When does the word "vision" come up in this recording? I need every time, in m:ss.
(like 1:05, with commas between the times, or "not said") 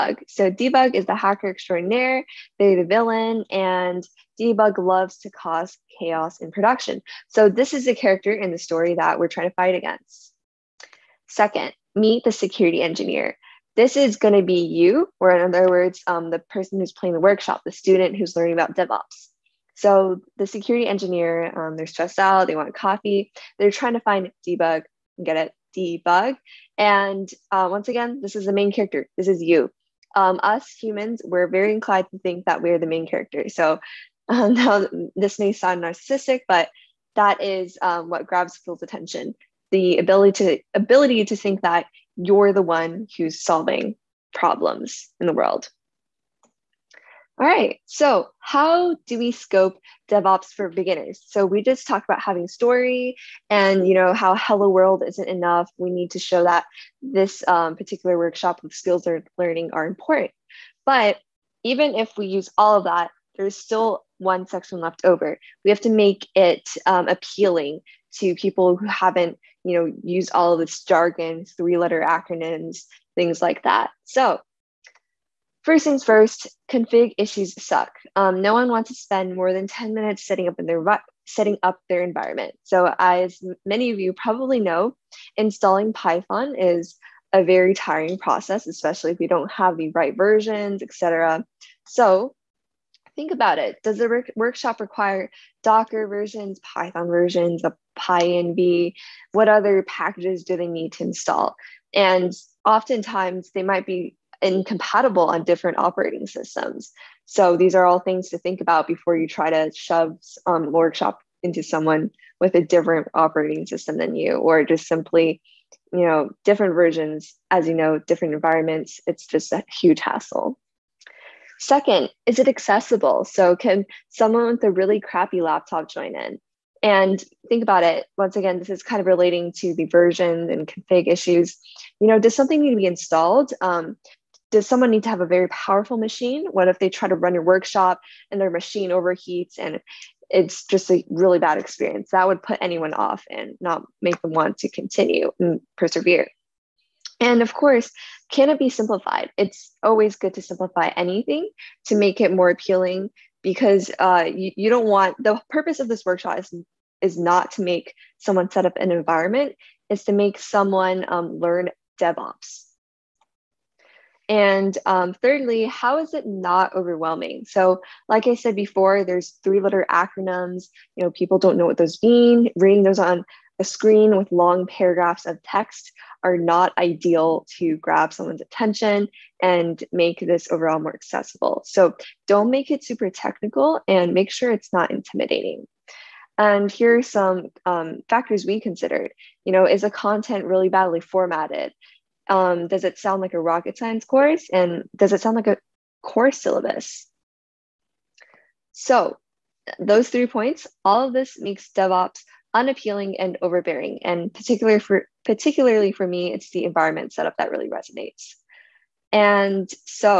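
not said.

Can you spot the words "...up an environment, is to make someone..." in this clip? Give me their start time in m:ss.
2:38.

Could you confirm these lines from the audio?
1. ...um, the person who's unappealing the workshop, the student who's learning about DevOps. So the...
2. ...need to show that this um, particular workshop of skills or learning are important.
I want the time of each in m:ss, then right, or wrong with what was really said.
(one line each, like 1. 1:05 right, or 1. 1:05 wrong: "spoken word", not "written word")
1. 0:16 wrong: "playing", not "unappealing"
2. 0:55 right.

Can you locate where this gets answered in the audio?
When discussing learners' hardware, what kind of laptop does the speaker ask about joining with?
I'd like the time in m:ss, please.
2:04.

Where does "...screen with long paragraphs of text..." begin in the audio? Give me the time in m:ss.
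2:53.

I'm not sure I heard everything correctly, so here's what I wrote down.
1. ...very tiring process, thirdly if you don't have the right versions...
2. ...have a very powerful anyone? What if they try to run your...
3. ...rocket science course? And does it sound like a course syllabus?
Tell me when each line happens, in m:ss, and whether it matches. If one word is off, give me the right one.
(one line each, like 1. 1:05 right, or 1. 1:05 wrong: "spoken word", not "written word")
1. 1:27 wrong: "especially", not "thirdly"
2. 2:15 wrong: "machine", not "anyone"
3. 3:13 right.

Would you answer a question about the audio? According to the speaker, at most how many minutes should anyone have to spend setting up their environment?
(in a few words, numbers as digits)
10 minutes.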